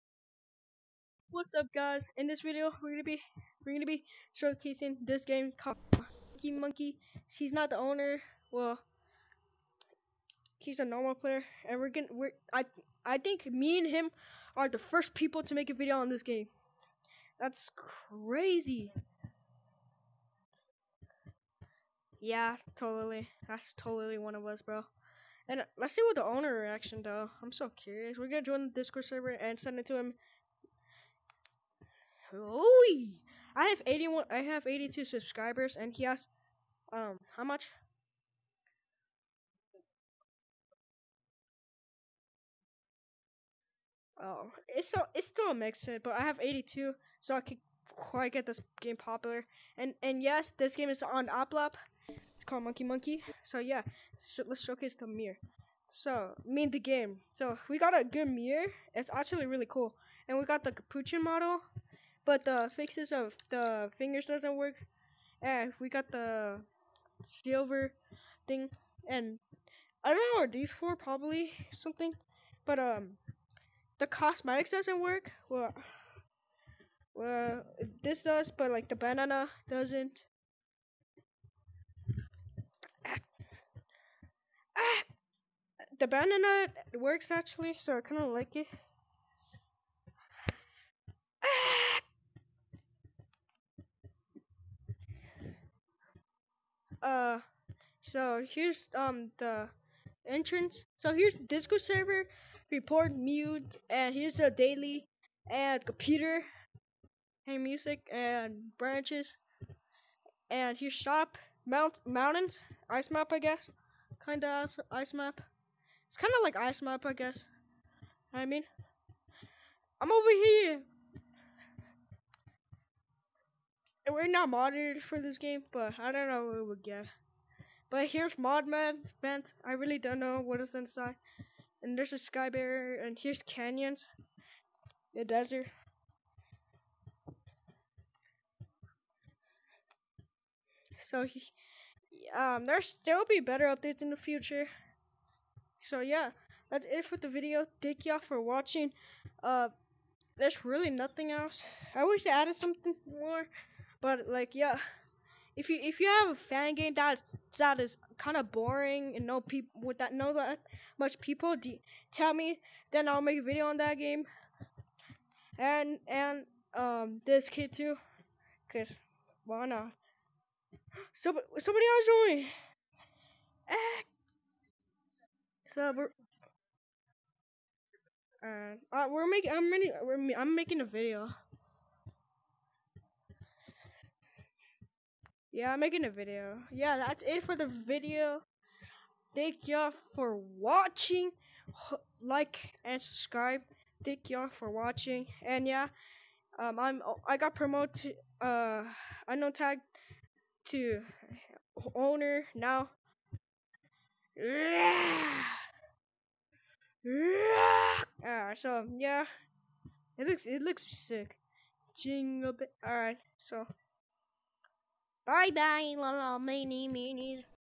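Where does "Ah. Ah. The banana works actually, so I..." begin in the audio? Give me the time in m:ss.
1:23.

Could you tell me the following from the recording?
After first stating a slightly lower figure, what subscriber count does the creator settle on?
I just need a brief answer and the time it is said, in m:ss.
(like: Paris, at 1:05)
82, at 0:34.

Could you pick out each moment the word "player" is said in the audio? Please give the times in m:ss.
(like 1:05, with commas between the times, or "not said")
0:11.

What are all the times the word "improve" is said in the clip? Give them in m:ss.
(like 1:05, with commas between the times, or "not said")
not said.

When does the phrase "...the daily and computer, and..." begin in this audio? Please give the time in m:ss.
1:44.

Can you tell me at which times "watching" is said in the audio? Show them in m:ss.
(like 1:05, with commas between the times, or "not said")
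2:28, 3:10, 3:14.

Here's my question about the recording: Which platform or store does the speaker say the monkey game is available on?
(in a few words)
App Lab.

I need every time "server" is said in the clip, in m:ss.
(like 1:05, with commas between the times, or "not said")
0:29, 1:41.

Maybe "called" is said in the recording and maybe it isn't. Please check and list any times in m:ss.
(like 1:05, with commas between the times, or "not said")
0:05, 0:52.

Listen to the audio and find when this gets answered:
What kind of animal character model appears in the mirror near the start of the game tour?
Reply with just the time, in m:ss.
1:00.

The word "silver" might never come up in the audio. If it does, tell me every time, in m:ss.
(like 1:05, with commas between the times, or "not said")
1:07.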